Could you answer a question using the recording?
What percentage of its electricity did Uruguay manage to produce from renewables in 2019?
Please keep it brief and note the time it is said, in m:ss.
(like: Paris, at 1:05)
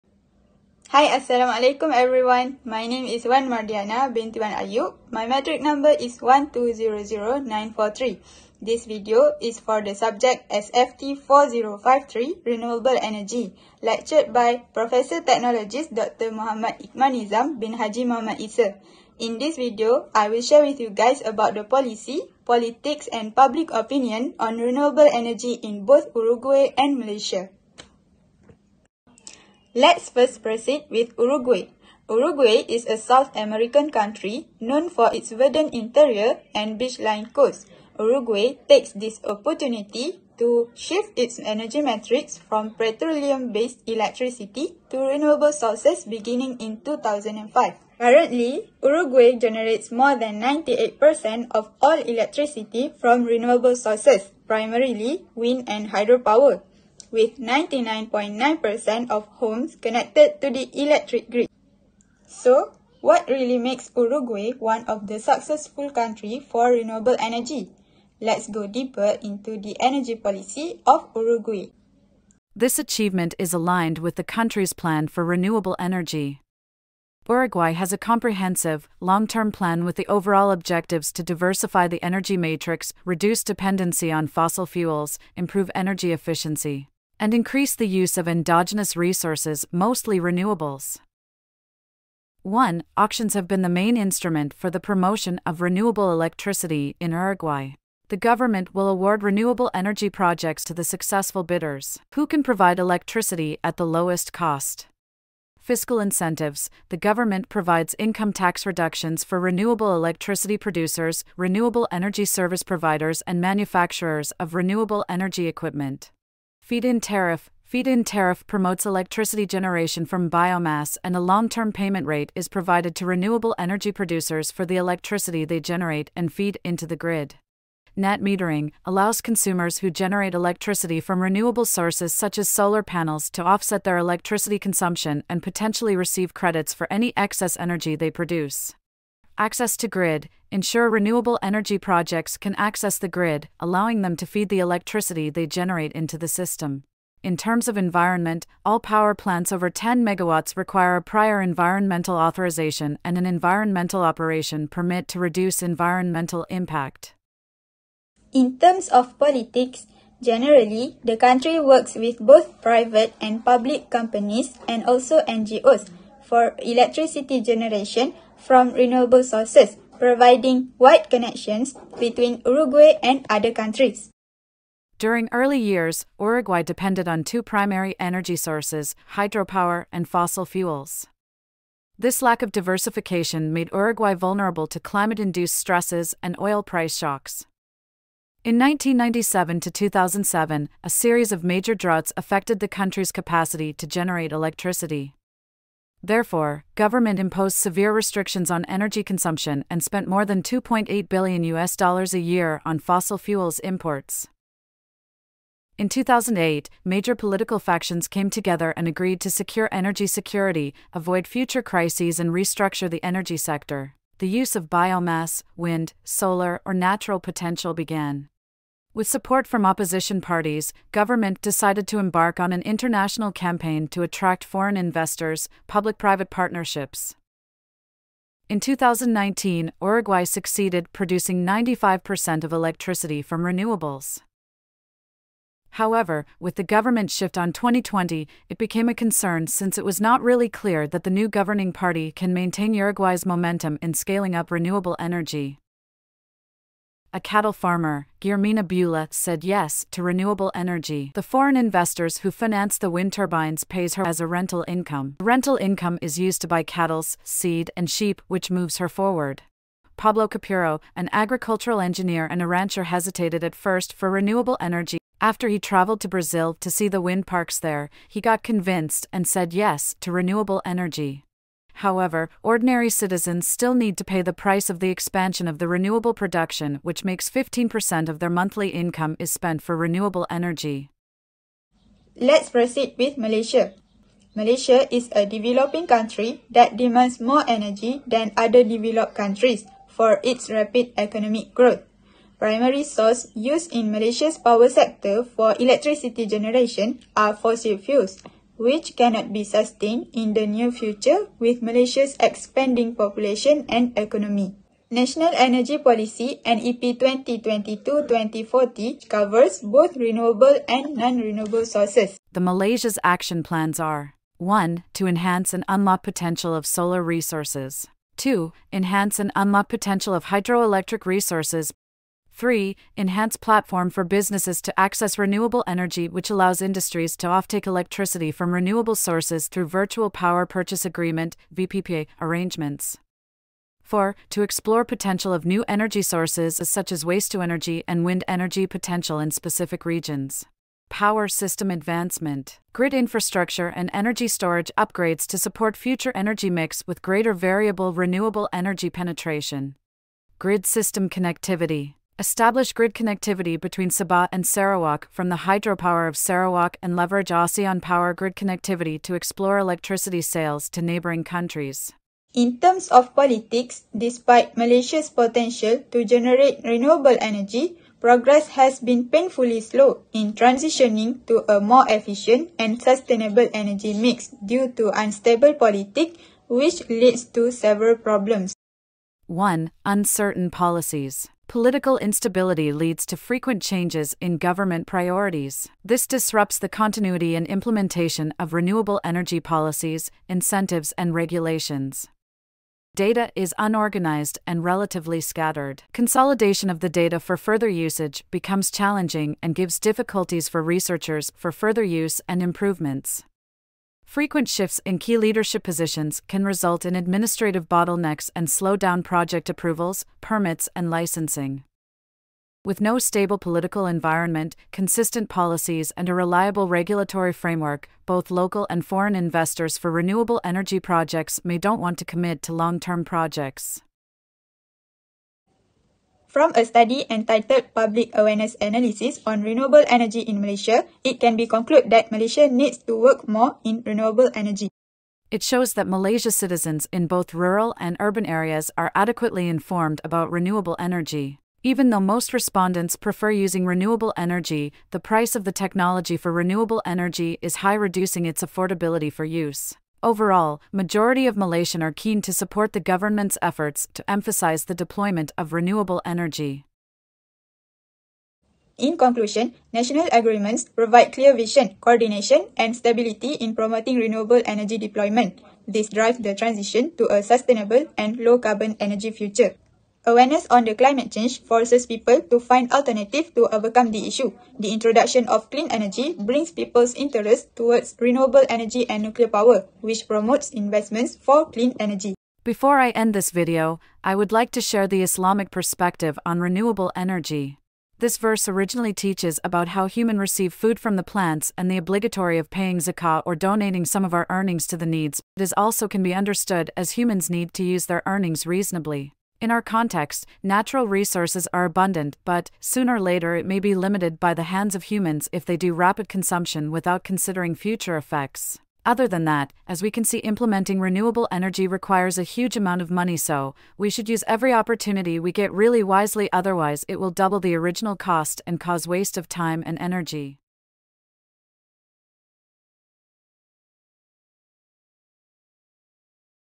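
95%, at 3:51.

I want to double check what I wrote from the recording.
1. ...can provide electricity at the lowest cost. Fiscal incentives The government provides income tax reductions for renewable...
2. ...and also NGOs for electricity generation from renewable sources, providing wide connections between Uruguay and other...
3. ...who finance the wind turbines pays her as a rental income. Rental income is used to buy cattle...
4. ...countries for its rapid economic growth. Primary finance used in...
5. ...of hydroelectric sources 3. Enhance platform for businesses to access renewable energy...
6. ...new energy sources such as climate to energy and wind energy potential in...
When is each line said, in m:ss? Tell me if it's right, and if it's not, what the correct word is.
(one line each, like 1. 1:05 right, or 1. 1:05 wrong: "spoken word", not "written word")
1. 1:42 right
2. 2:44 right
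3. 4:12 right
4. 4:49 wrong: "source", not "finance"
5. 5:20 wrong: "resources", not "sources"
6. 5:35 wrong: "waste", not "climate".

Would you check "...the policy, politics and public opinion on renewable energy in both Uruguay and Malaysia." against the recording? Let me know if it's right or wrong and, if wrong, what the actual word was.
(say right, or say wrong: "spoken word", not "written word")
right.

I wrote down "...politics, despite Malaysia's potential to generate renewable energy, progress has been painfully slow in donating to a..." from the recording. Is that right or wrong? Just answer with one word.
wrong.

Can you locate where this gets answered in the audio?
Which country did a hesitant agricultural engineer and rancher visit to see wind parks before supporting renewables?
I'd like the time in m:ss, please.
4:26.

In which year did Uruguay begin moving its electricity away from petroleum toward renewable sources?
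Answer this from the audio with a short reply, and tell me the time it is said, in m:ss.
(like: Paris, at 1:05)
2005, at 0:46.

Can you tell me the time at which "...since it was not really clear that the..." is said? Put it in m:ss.
3:59.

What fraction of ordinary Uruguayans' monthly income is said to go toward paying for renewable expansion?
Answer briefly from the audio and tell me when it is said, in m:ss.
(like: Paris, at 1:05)
15%, at 4:37.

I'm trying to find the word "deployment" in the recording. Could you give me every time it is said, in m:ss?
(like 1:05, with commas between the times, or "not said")
7:34, 7:44.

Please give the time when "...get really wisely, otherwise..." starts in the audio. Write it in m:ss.
8:35.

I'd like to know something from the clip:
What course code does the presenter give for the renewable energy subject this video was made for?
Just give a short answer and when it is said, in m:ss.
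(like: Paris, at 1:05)
SFT 4053, at 0:10.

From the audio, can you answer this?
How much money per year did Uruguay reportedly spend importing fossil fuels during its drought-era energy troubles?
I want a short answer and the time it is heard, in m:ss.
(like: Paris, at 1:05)
2.8 billion US dollars, at 3:20.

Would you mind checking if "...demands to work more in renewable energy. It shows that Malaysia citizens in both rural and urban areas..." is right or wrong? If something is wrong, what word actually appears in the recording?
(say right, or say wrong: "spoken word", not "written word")
wrong: "needs", not "demands".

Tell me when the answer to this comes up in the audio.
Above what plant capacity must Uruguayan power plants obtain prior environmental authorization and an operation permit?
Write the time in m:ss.
2:29.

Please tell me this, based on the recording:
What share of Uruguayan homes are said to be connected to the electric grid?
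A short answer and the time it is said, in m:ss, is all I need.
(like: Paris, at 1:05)
99.9%, at 0:57.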